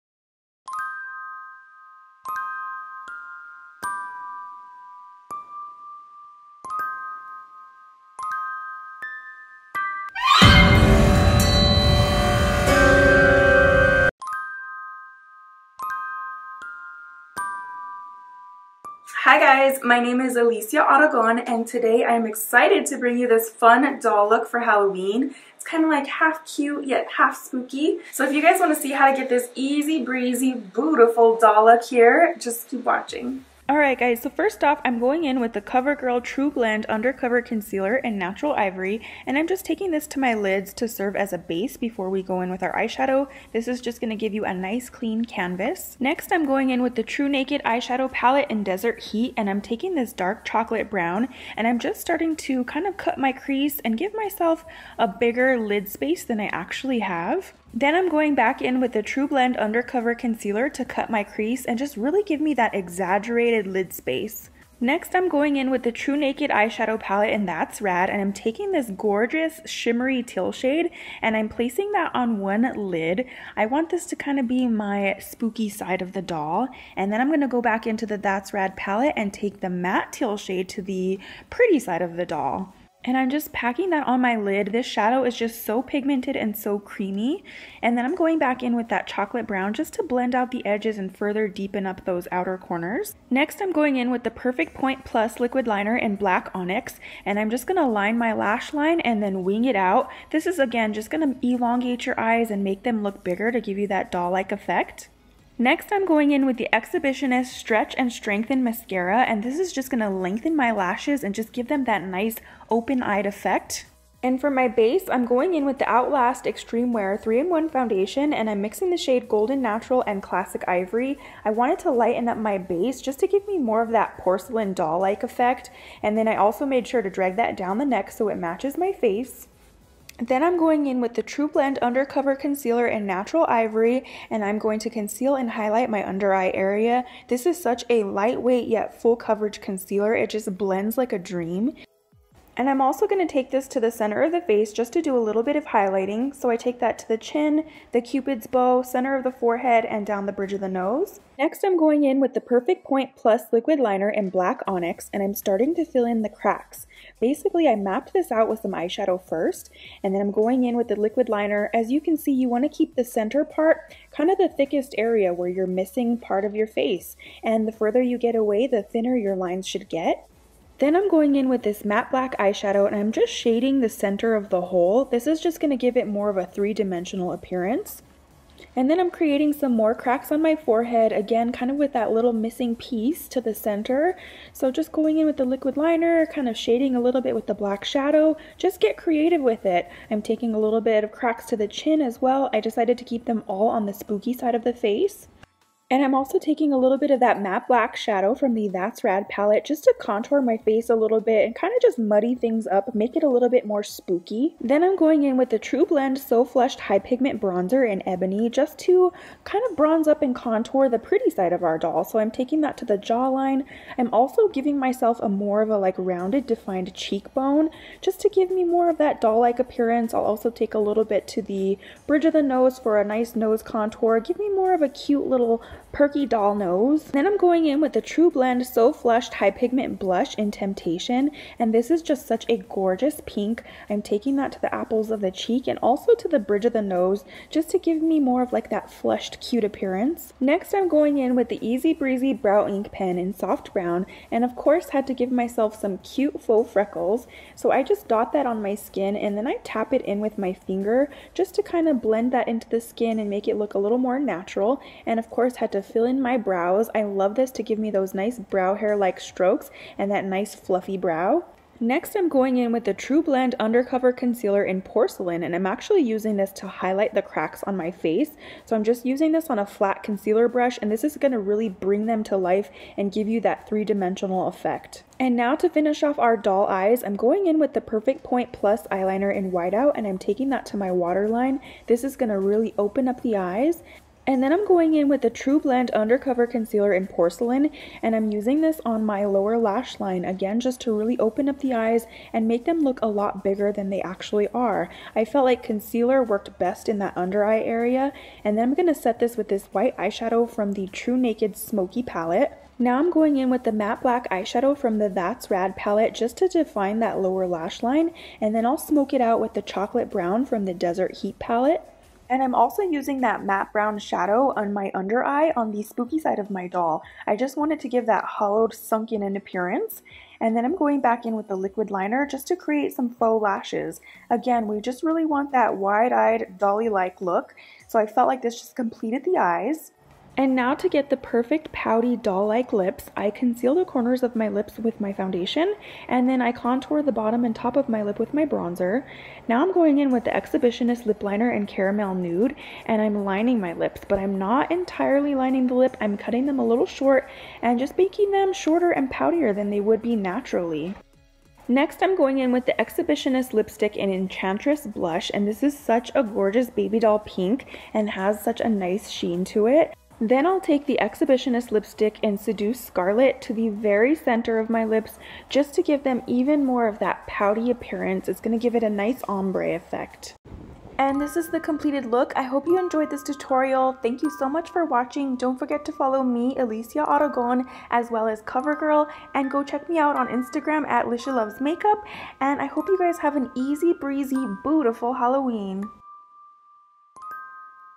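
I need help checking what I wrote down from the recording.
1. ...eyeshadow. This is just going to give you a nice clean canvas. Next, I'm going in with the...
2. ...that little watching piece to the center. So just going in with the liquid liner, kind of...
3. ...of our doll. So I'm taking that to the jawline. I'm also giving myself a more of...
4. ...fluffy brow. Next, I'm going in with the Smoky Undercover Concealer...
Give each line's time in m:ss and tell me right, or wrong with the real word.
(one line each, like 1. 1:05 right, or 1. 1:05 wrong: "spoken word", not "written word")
1. 0:42 right
2. 3:01 wrong: "missing", not "watching"
3. 3:31 right
4. 4:20 wrong: "Trublend", not "Smoky".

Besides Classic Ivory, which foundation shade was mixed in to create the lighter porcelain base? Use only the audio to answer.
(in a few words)
Golden Natural.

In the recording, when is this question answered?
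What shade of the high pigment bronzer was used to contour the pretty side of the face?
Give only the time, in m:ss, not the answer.
3:28.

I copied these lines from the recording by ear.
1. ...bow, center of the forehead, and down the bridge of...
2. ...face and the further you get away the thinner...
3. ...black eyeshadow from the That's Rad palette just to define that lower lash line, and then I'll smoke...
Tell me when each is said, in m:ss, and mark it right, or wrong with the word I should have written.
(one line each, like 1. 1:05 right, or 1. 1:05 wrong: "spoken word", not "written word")
1. 2:28 right
2. 2:46 right
3. 5:04 right.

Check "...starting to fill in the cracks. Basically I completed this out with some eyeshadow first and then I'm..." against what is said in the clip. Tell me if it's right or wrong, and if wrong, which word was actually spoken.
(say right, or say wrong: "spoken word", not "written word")
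wrong: "mapped", not "completed".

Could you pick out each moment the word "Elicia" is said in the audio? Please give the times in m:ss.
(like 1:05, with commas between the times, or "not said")
0:20, 6:16.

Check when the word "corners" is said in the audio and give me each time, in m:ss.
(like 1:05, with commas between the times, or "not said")
1:32, 5:33.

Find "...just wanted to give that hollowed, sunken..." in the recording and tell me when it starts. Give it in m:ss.
5:17.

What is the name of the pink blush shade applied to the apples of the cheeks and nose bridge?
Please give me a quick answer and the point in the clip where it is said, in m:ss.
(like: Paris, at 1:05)
Temptation, at 3:50.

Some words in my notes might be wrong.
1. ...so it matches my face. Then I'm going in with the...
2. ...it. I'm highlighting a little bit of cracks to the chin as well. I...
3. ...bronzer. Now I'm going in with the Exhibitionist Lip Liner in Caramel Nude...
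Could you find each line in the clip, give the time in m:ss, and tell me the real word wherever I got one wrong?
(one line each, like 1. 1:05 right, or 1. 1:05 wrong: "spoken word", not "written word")
1. 2:08 right
2. 3:09 wrong: "taking", not "highlighting"
3. 5:38 right.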